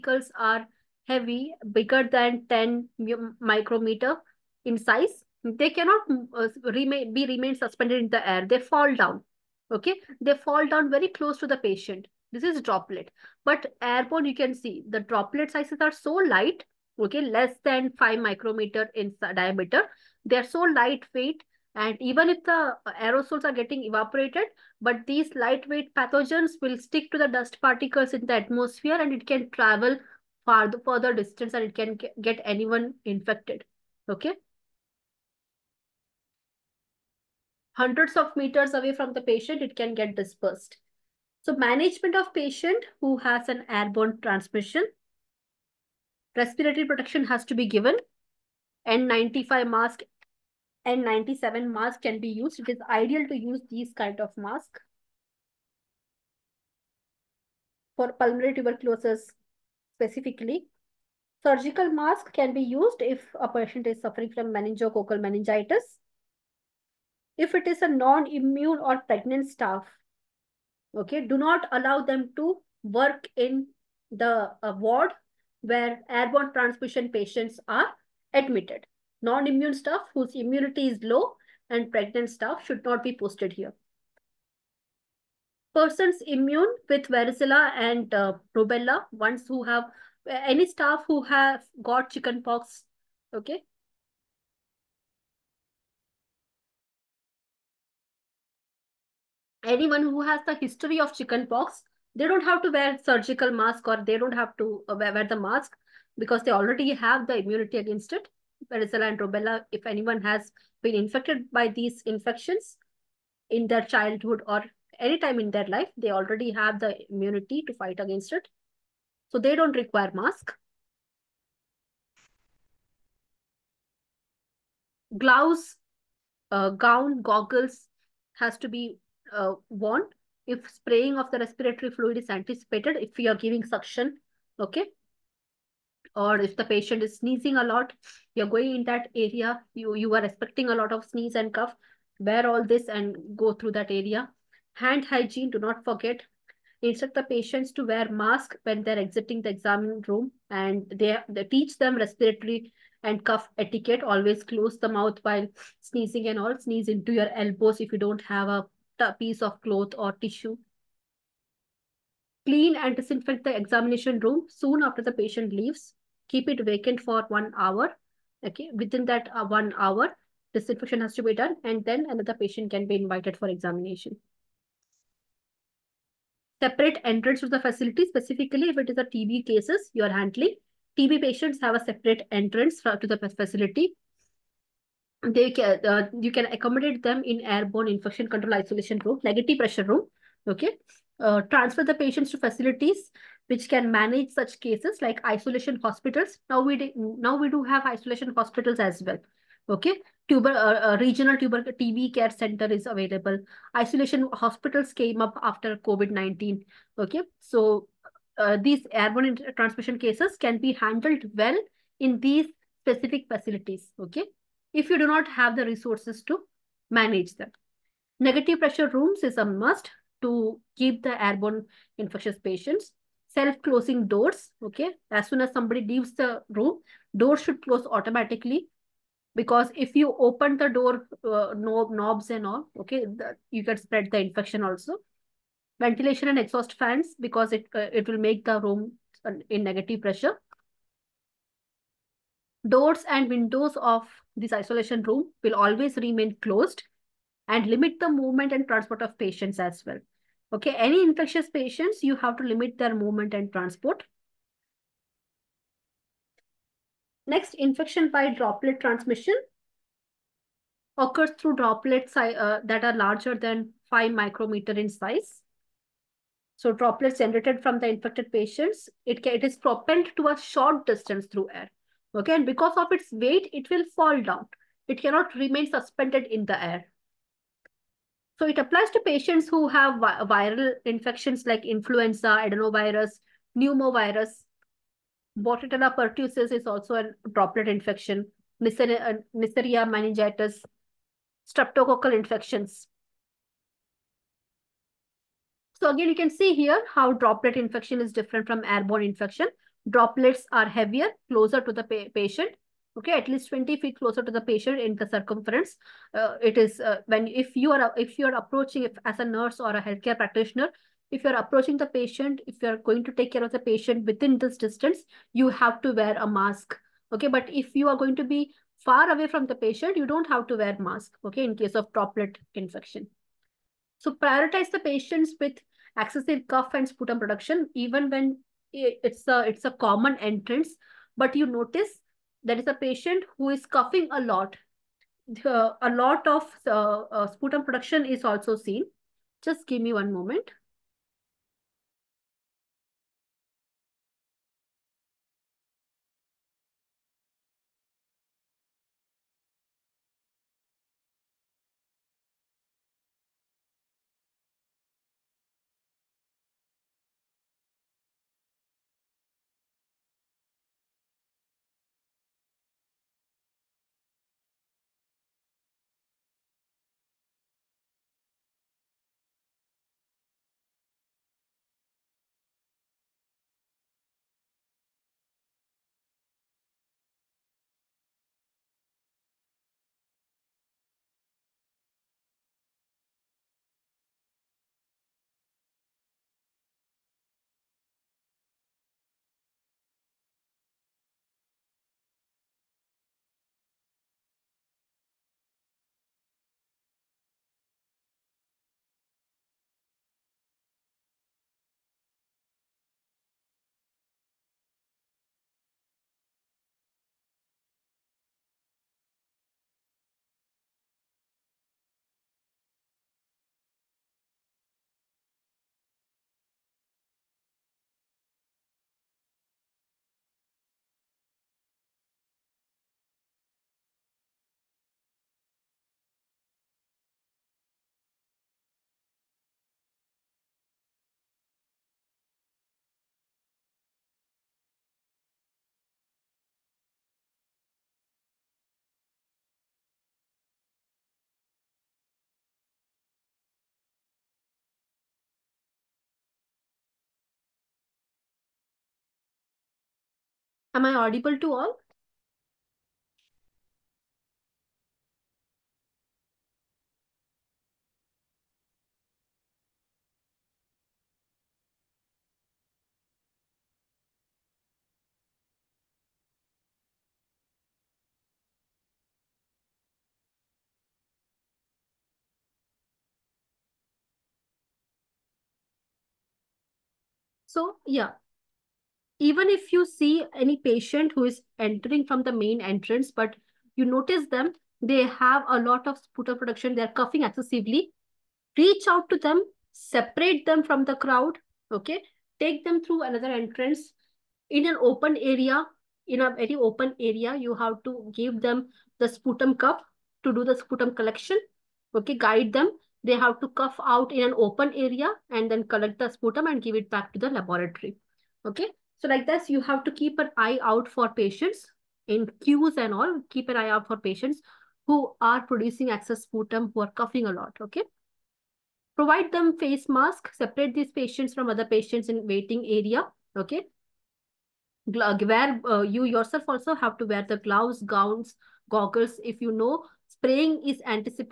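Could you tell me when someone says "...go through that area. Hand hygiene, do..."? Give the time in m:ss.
2:23.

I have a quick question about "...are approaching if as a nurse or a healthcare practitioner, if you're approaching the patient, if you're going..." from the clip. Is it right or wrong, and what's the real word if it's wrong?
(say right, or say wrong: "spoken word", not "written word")
right.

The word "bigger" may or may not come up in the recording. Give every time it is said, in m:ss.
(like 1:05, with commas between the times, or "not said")
0:01.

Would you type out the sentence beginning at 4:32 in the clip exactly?
Okay, and because of its weight, it will fall down.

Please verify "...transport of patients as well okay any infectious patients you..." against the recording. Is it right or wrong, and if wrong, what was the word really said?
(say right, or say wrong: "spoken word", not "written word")
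right.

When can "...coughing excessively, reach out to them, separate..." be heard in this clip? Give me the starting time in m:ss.
8:07.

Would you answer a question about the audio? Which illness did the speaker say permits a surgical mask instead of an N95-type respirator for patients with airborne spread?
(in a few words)
Meningococcal meningitis.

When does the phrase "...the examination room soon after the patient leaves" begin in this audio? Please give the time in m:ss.
2:43.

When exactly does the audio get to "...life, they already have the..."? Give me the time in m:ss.
1:55.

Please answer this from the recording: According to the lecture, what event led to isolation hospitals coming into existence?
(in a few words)
COVID-19.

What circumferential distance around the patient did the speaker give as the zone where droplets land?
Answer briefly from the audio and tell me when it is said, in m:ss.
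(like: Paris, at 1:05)
20 feet, at 5:03.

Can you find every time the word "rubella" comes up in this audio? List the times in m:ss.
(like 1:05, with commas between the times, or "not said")
1:28, 1:49.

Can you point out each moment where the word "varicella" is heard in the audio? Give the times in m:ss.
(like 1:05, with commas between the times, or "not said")
1:27, 1:48.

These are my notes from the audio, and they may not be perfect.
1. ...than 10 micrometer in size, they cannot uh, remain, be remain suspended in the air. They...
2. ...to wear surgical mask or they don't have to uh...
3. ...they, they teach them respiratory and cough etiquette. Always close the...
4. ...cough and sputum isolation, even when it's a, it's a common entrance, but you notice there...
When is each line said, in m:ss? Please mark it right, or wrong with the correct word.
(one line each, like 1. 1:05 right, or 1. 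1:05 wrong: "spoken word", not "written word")
1. 0:02 right
2. 1:42 right
3. 2:30 right
4. 5:26 wrong: "production", not "isolation".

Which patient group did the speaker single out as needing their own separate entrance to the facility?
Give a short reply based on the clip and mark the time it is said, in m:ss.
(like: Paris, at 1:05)
TB patients, at 3:00.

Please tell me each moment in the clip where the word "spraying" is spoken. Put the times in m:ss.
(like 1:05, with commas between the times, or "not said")
2:10, 8:50.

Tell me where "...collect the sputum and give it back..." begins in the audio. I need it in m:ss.
8:25.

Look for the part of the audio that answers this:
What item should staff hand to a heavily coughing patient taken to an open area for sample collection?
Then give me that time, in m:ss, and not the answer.
8:19.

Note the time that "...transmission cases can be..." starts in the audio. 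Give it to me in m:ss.
3:29.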